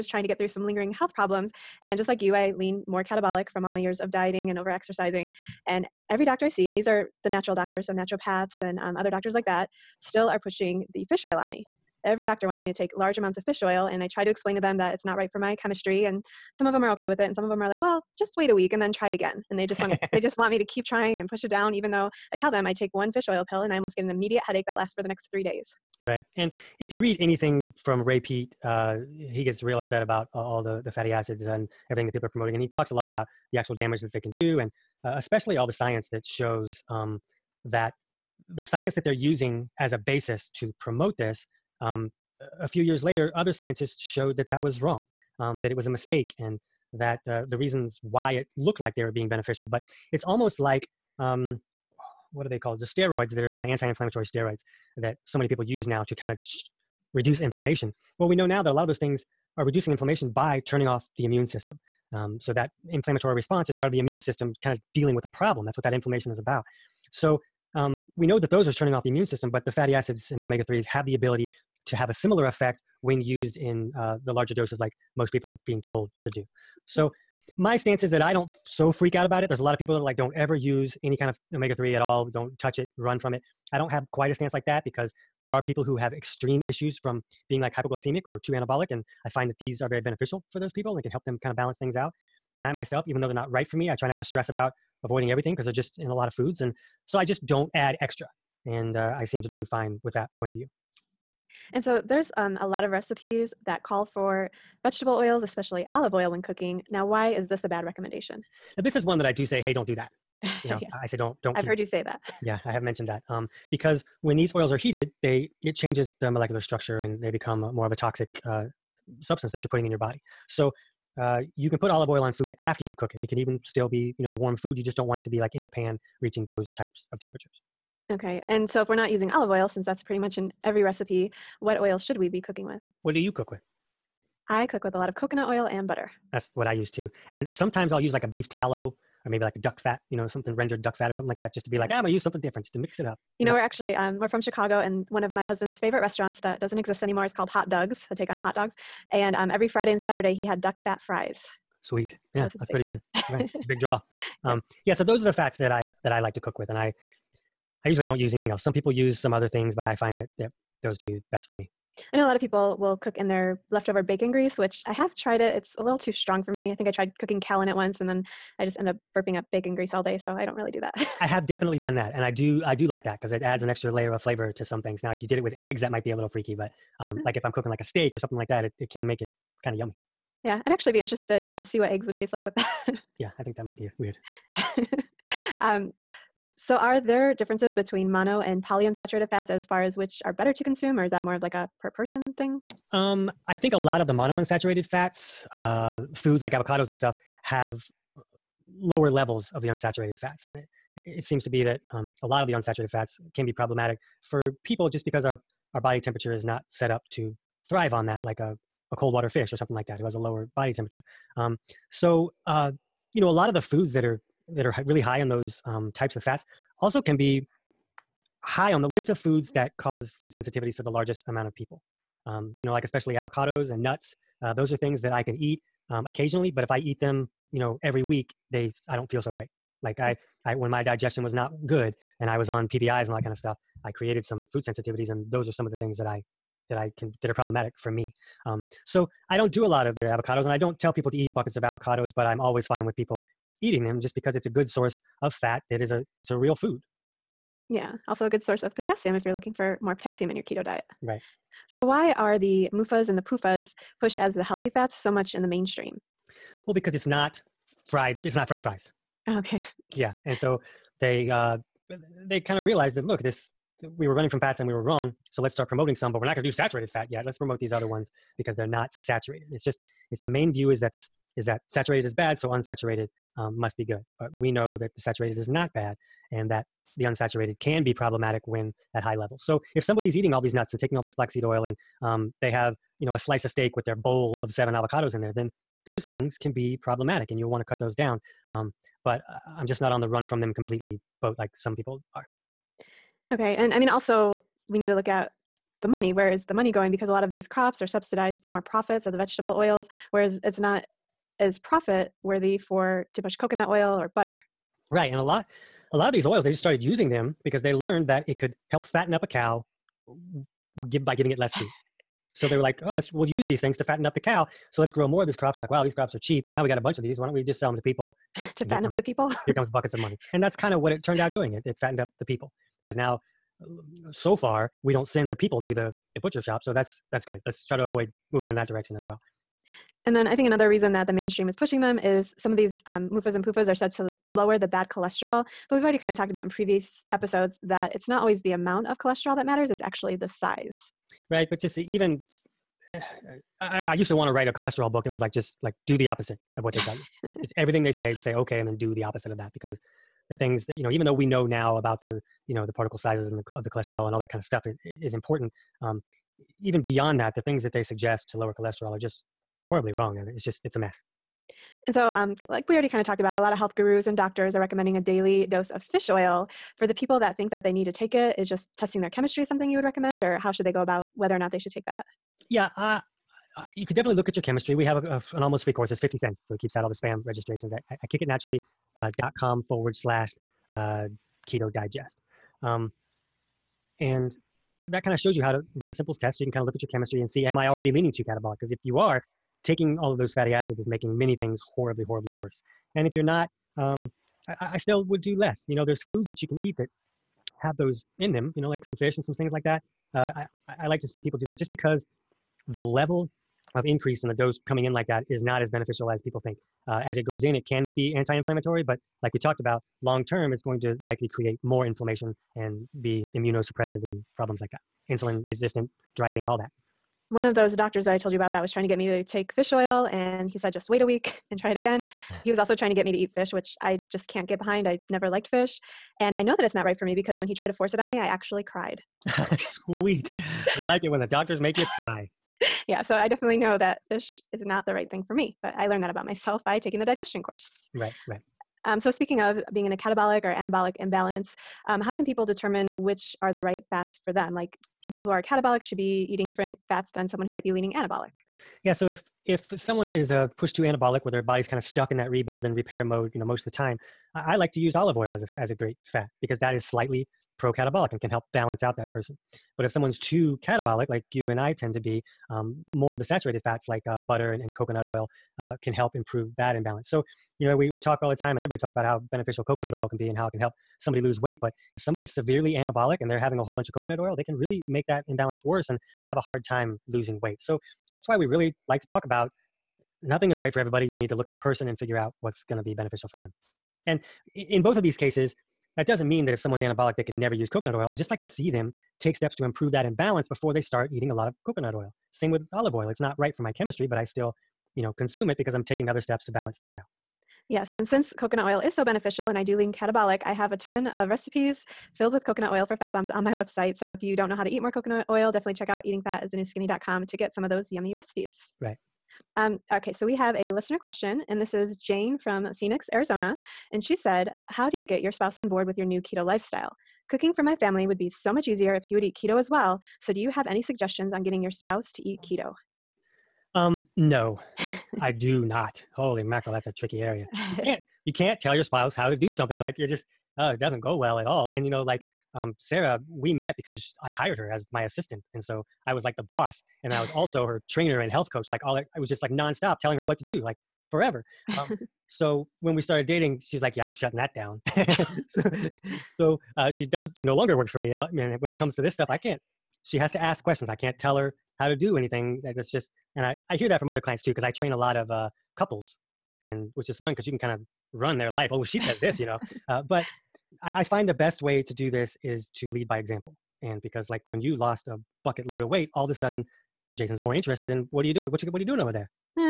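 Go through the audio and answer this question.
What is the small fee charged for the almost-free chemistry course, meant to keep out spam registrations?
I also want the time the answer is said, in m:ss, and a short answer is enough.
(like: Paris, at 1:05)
50 cents, at 6:15.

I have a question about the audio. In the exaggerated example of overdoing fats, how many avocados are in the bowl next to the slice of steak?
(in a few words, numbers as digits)
7.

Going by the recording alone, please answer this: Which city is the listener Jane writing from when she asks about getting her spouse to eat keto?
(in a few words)
Phoenix, Arizona.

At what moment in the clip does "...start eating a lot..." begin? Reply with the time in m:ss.
8:10.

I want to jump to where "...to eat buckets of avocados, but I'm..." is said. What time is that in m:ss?
4:01.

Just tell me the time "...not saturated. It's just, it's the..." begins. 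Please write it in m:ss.
4:28.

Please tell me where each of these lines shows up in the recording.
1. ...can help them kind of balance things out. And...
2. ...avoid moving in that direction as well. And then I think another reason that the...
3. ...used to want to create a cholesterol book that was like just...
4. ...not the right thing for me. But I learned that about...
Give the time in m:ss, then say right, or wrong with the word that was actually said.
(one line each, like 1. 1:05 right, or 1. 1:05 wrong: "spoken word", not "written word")
1. 1:31 right
2. 5:27 right
3. 5:43 wrong: "write", not "create"
4. 7:14 right.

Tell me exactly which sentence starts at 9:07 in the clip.
She no longer works for me, and, uh, when it comes to this stuff, I can't.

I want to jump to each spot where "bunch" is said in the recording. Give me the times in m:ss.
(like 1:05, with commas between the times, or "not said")
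5:16, 7:53.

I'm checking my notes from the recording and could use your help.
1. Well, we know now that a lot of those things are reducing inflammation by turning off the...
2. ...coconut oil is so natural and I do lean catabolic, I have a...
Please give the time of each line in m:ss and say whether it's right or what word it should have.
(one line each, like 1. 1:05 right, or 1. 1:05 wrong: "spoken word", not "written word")
1. 0:58 right
2. 8:18 wrong: "beneficial", not "natural".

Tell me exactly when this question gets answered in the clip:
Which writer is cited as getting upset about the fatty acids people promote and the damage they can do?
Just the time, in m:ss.
0:28.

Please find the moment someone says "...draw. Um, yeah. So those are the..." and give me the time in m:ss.
2:33.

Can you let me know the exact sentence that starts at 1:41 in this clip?
And so there's um, a lot of recipes that call for vegetable oils, especially olive oil when cooking.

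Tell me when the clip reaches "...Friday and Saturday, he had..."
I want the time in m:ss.
2:29.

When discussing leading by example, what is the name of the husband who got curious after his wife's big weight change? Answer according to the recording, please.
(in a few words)
Jason.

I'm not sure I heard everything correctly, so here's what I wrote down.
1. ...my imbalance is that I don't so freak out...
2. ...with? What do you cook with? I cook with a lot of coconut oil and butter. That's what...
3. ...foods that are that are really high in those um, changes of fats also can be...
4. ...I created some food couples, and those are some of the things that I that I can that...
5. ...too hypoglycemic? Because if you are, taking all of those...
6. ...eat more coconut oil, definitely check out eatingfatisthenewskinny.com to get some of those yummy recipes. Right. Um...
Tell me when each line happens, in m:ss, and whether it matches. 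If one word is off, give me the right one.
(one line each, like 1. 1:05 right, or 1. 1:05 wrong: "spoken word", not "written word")
1. 1:17 wrong: "stance", not "imbalance"
2. 2:12 right
3. 3:33 wrong: "types", not "changes"
4. 3:53 wrong: "sensitivities", not "couples"
5. 6:28 wrong: "catabolic", not "hypoglycemic"
6. 8:24 right.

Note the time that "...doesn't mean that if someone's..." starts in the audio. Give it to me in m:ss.
8:06.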